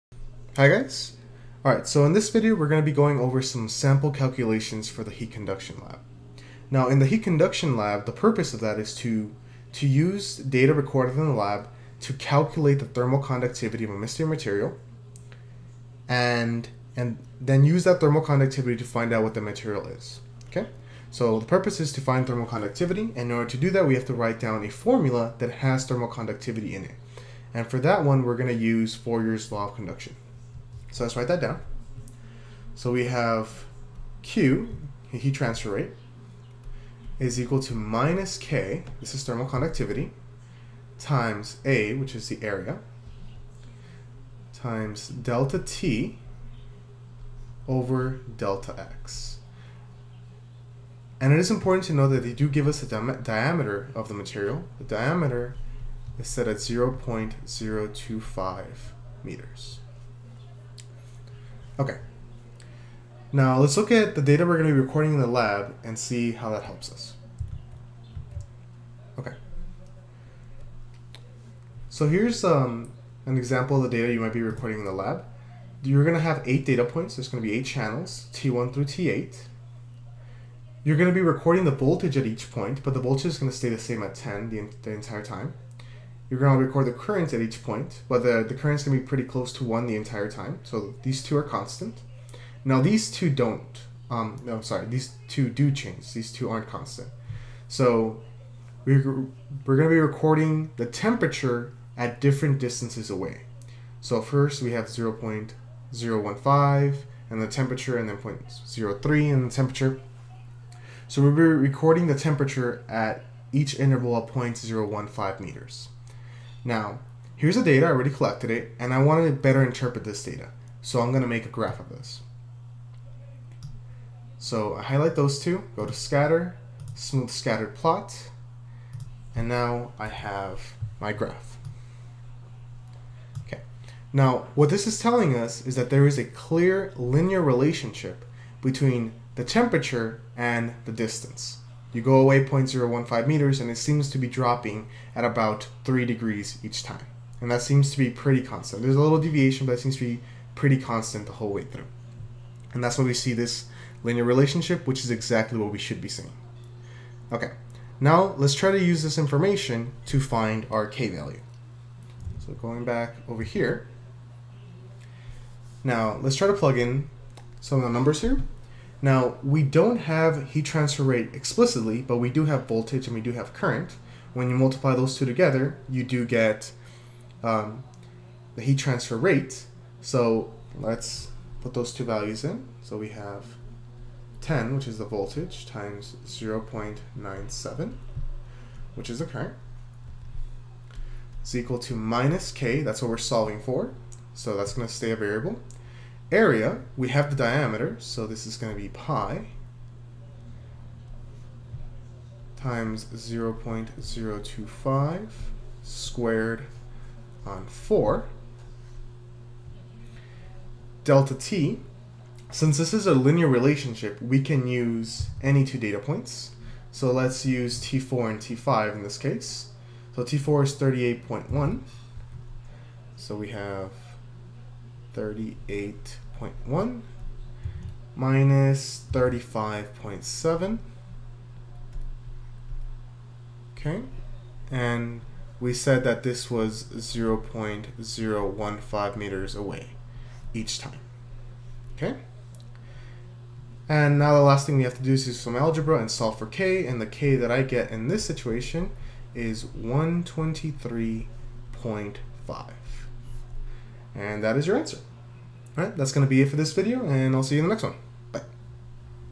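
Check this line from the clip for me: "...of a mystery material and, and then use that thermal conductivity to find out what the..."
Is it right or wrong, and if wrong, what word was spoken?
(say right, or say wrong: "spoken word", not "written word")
right.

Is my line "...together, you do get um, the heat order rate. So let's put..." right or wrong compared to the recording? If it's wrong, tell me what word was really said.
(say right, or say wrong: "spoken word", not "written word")
wrong: "transfer", not "order".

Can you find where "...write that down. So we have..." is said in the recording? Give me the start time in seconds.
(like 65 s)
31 s.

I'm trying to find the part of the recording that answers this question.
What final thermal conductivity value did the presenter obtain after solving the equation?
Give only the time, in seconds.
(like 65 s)
249 s.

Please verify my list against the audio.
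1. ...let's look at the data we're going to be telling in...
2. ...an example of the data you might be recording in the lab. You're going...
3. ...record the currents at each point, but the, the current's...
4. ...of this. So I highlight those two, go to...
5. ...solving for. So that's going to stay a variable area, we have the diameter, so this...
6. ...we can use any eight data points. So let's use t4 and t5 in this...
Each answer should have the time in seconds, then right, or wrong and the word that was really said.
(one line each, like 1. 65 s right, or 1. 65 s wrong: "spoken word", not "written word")
1. 63 s wrong: "recording", not "telling"
2. 73 s right
3. 86 s right
4. 121 s right
5. 193 s right
6. 214 s wrong: "two", not "eight".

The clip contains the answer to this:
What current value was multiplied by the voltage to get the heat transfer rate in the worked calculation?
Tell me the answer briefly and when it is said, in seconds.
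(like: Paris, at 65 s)
0.97, at 186 s.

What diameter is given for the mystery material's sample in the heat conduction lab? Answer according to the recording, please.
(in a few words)
0.025 meters.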